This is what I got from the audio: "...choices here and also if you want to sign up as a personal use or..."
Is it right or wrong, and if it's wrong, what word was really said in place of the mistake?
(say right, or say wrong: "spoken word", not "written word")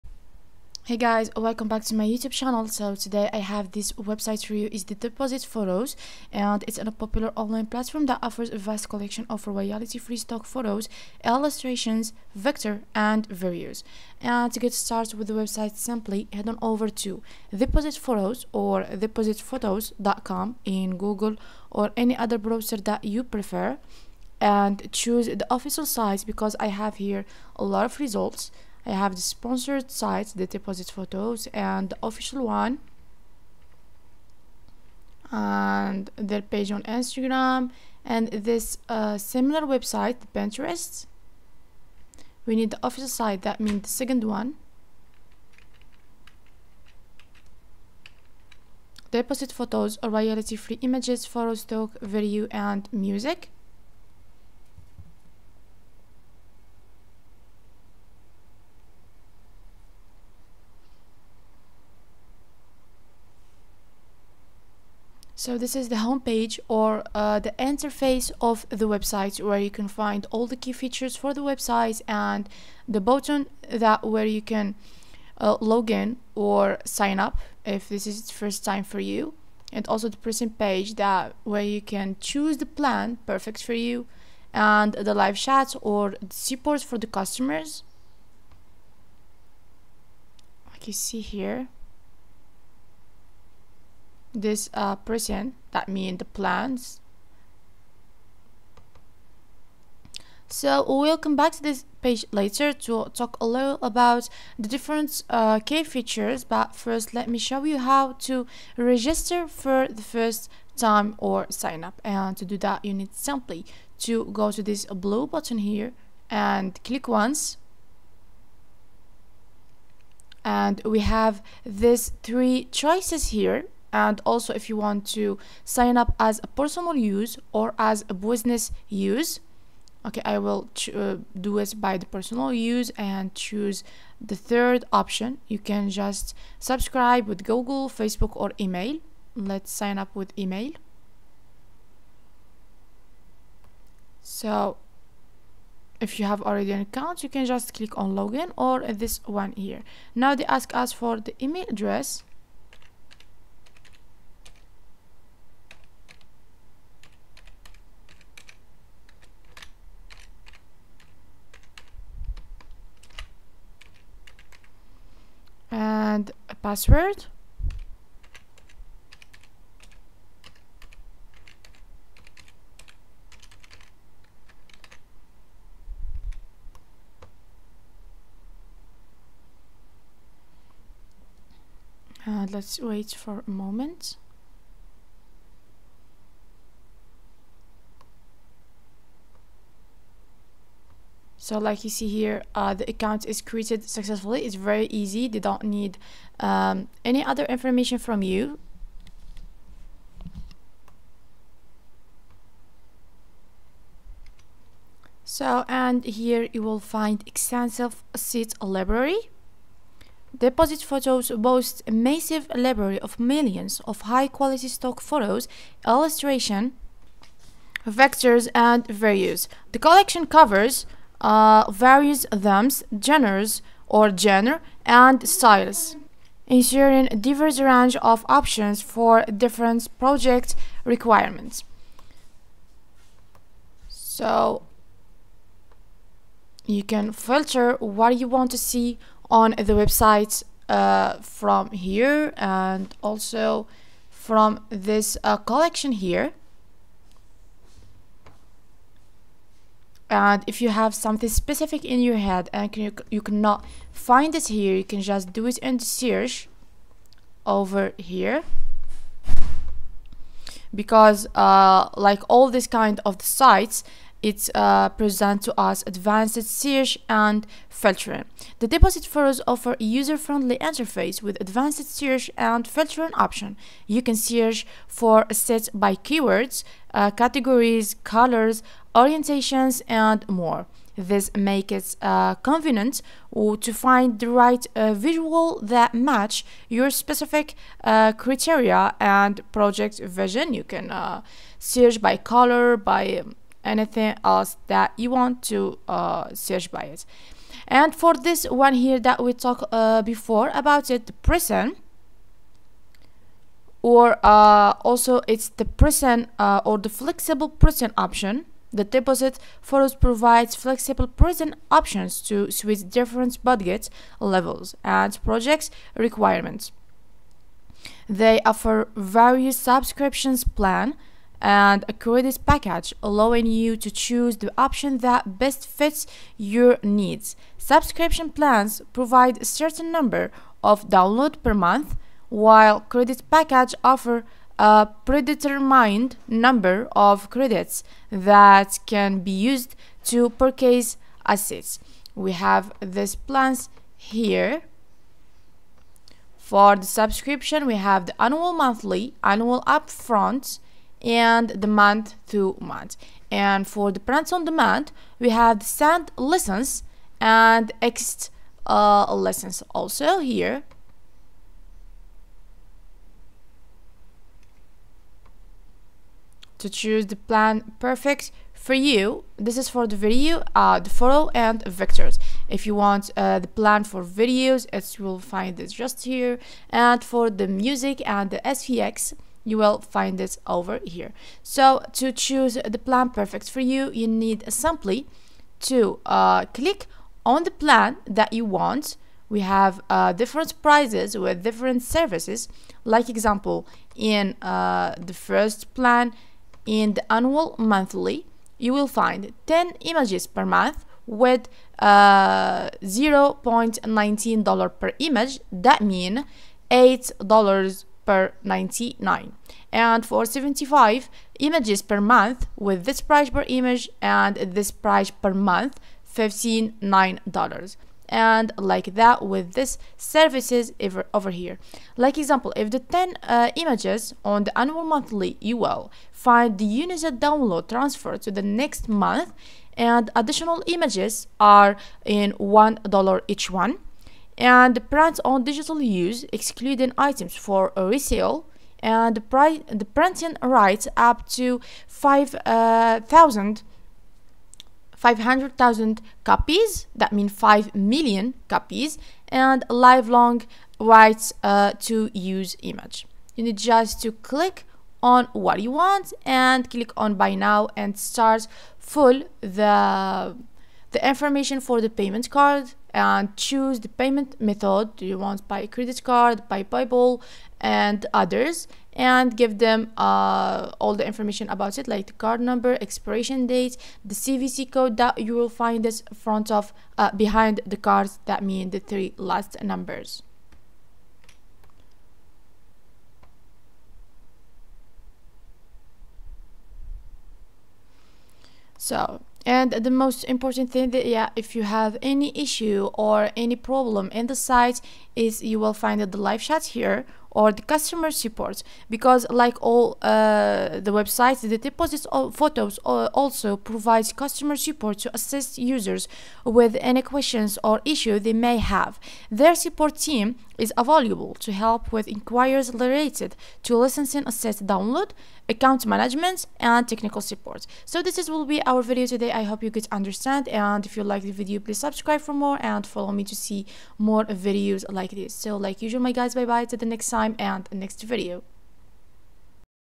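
right.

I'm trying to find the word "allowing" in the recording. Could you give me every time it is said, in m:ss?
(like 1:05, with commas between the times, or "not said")
5:23.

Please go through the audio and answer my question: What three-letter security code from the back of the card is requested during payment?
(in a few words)
CVC.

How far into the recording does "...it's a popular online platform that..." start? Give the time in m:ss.
0:06.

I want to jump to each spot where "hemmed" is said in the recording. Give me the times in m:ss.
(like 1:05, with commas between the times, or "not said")
not said.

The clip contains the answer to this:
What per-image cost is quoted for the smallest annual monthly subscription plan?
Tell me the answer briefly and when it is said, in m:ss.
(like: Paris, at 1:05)
$0.19, at 6:42.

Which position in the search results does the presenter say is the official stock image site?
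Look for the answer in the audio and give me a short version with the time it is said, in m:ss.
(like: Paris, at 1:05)
second, at 0:43.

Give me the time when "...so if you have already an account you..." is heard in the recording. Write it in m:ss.
2:24.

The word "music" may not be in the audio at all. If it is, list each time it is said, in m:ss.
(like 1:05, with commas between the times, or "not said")
0:52, 6:17.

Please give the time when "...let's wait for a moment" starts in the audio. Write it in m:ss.
3:02.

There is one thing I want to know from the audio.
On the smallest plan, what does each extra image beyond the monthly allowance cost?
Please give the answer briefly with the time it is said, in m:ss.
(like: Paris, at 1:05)
1 dollar, at 7:12.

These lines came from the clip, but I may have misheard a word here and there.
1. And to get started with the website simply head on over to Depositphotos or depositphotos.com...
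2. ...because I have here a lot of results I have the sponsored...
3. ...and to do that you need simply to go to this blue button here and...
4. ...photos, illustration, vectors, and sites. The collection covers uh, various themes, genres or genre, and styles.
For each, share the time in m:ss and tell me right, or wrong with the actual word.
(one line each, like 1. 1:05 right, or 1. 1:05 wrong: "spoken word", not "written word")
1. 0:14 right
2. 0:26 right
3. 1:52 right
4. 3:35 wrong: "values", not "sites".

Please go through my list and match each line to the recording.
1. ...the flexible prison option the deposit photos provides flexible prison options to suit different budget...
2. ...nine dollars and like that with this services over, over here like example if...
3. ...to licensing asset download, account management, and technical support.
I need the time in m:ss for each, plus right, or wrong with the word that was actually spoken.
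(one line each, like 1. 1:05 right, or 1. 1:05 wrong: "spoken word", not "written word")
1. 5:06 right
2. 6:56 right
3. 8:33 right.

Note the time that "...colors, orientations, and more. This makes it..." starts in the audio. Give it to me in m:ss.
4:38.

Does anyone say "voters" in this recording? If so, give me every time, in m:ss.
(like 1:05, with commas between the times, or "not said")
not said.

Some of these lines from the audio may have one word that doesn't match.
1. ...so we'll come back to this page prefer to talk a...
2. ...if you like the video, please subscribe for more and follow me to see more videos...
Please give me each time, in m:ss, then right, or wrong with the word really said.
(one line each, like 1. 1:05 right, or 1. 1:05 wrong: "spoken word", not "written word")
1. 1:40 wrong: "later", not "prefer"
2. 8:40 right.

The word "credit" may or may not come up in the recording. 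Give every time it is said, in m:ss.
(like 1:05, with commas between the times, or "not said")
5:21, 5:32, 5:37, 7:45.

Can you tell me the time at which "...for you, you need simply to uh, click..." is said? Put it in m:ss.
6:23.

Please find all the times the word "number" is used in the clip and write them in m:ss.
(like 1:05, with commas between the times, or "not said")
5:29, 5:36, 7:52, 7:59.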